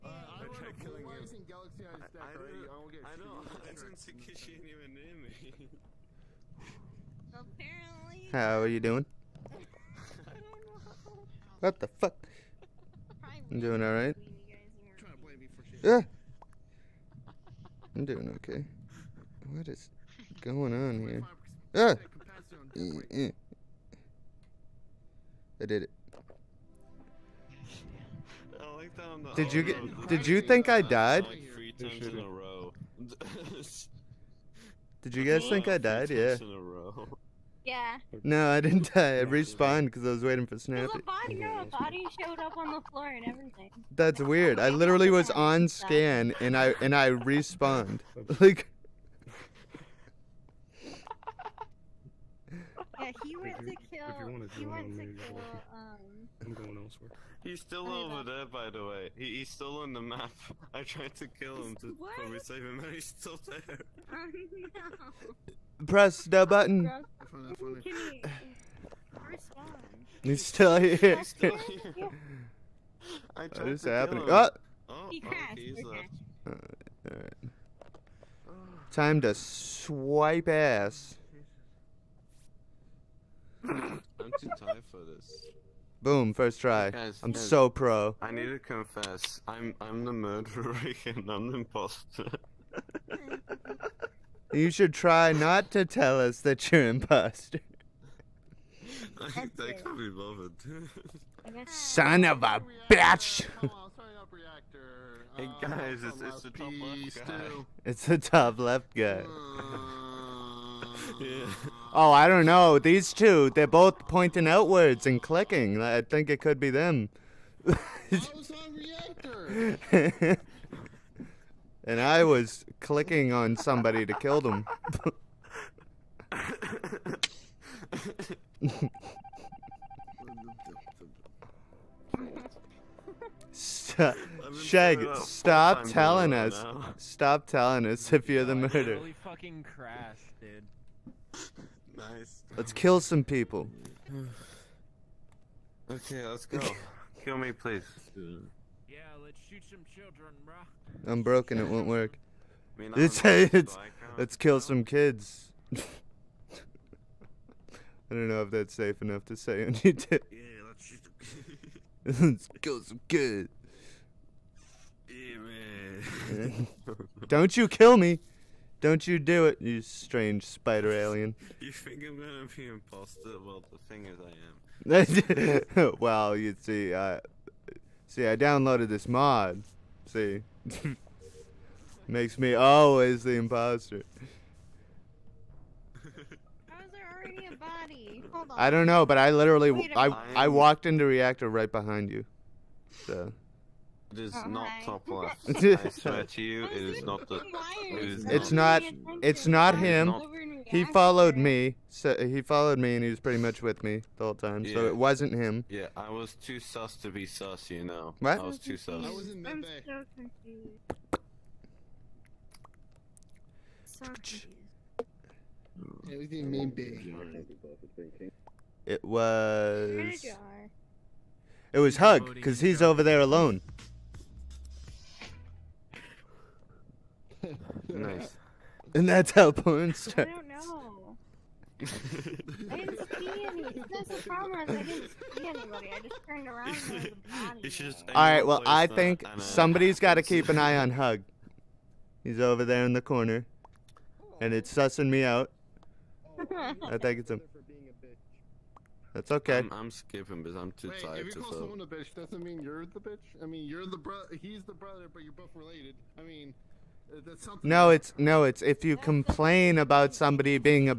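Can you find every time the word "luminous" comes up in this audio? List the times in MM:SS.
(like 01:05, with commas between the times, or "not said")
not said.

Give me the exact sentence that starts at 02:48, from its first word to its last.
Don't you do it, you strange spider alien.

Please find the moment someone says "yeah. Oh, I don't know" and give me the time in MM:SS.
01:51.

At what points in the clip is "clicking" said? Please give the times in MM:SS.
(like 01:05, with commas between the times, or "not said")
01:55, 02:02.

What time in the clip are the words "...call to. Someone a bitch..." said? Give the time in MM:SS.
04:11.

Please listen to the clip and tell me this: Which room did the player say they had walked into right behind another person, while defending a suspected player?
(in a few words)
Reactor.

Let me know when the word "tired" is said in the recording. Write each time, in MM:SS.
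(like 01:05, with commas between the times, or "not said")
01:24, 04:11.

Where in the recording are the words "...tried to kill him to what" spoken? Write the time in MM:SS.
01:00.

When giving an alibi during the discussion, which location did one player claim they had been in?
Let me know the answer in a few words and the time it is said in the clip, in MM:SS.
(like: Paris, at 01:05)
Mid bay, at 03:29.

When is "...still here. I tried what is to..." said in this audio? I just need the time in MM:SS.
01:11.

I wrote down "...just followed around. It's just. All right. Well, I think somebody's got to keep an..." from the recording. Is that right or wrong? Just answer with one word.
wrong.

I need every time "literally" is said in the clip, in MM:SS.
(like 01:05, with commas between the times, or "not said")
00:44, 03:09.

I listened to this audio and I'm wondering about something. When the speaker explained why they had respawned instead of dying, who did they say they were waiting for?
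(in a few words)
Snappy.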